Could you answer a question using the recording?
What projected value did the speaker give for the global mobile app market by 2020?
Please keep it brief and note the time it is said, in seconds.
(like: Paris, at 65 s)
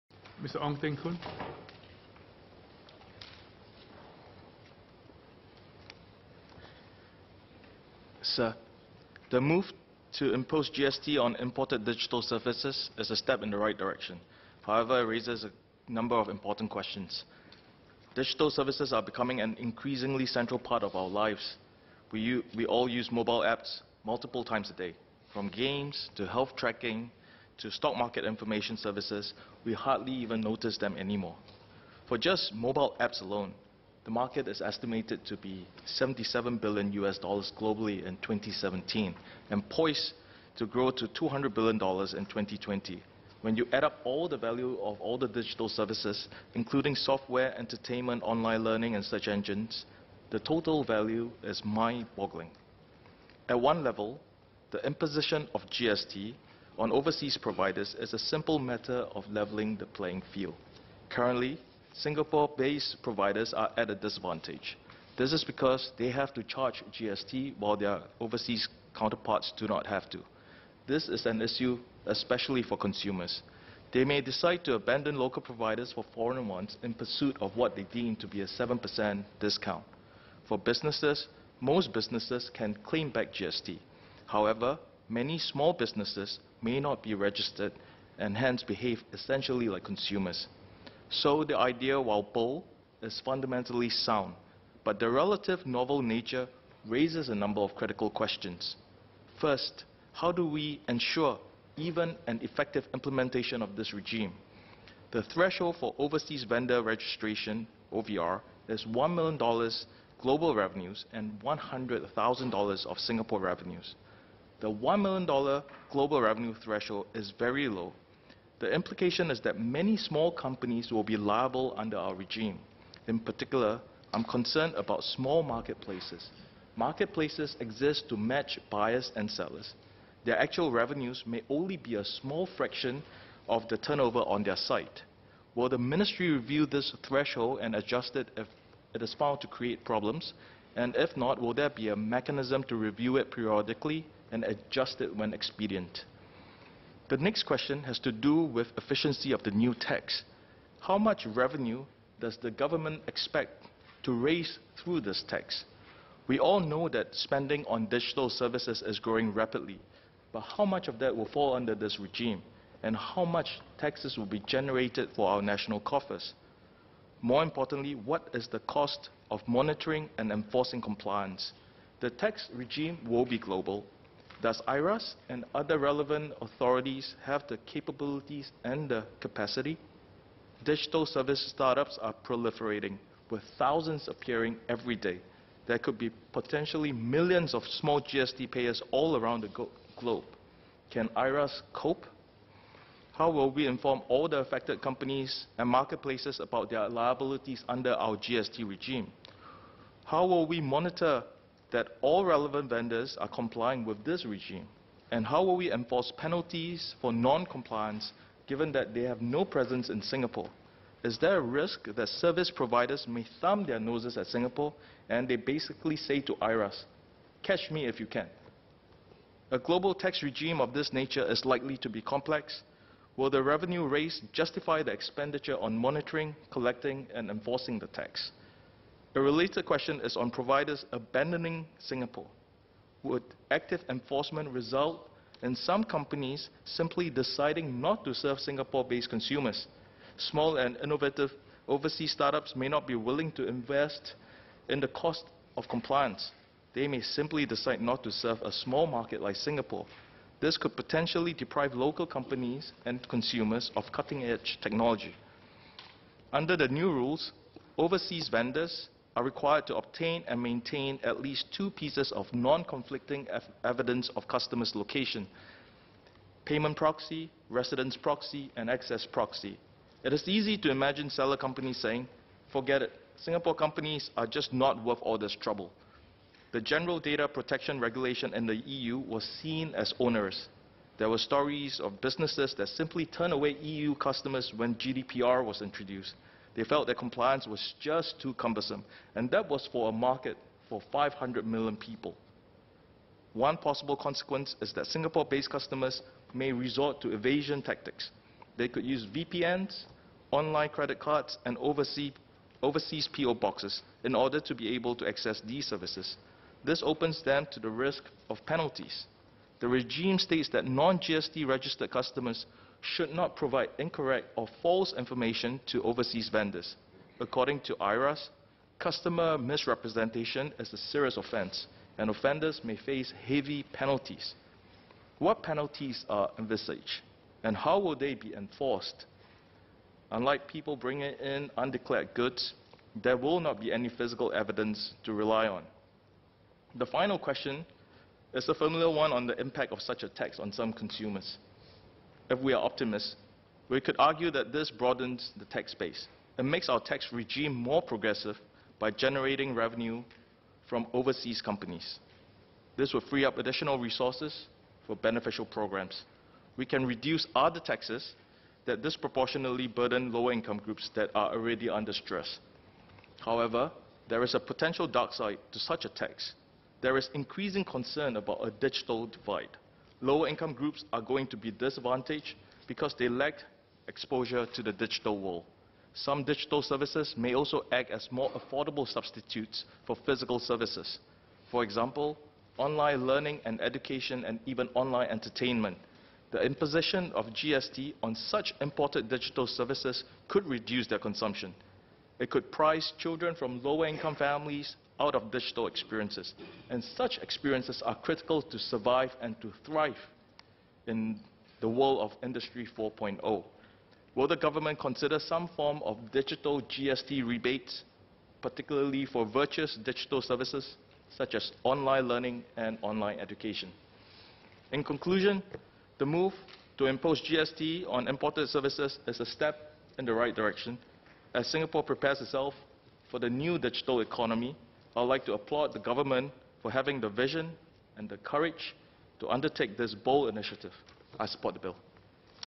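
200 billion dollars, at 41 s.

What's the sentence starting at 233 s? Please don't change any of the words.
Would active enforcement result in some companies simply deciding not to serve Singapore-based consumers?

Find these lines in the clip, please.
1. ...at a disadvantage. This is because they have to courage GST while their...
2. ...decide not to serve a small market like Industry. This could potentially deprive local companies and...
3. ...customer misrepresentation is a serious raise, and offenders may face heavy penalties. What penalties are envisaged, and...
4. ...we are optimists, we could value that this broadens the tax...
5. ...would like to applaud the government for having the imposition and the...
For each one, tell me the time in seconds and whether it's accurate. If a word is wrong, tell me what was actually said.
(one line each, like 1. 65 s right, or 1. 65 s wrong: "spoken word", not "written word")
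1. 63 s wrong: "charge", not "courage"
2. 247 s wrong: "Singapore", not "Industry"
3. 318 s wrong: "offense", not "raise"
4. 342 s wrong: "argue", not "value"
5. 424 s wrong: "vision", not "imposition".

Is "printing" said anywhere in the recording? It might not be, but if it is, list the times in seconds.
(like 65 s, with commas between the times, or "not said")
not said.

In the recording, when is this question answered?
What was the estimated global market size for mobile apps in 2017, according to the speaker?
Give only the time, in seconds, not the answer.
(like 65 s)
35 s.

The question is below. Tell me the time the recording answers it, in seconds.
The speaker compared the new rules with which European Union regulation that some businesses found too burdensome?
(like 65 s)
276 s.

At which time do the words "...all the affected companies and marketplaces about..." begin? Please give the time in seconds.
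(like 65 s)
194 s.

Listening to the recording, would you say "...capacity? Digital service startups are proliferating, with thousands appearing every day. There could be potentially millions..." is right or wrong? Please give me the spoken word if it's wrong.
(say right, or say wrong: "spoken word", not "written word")
right.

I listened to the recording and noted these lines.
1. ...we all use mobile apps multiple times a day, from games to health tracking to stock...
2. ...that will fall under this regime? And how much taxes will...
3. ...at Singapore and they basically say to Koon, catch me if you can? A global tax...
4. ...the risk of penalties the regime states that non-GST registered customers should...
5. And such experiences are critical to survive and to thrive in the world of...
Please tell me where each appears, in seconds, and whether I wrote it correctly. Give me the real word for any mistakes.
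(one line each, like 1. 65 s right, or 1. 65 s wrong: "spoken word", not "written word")
1. 22 s right
2. 160 s right
3. 214 s wrong: "IRAS", not "Koon"
4. 307 s right
5. 396 s right.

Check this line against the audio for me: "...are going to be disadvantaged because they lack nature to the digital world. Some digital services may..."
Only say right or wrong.
wrong.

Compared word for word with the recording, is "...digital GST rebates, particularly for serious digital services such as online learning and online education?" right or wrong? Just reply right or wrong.
wrong.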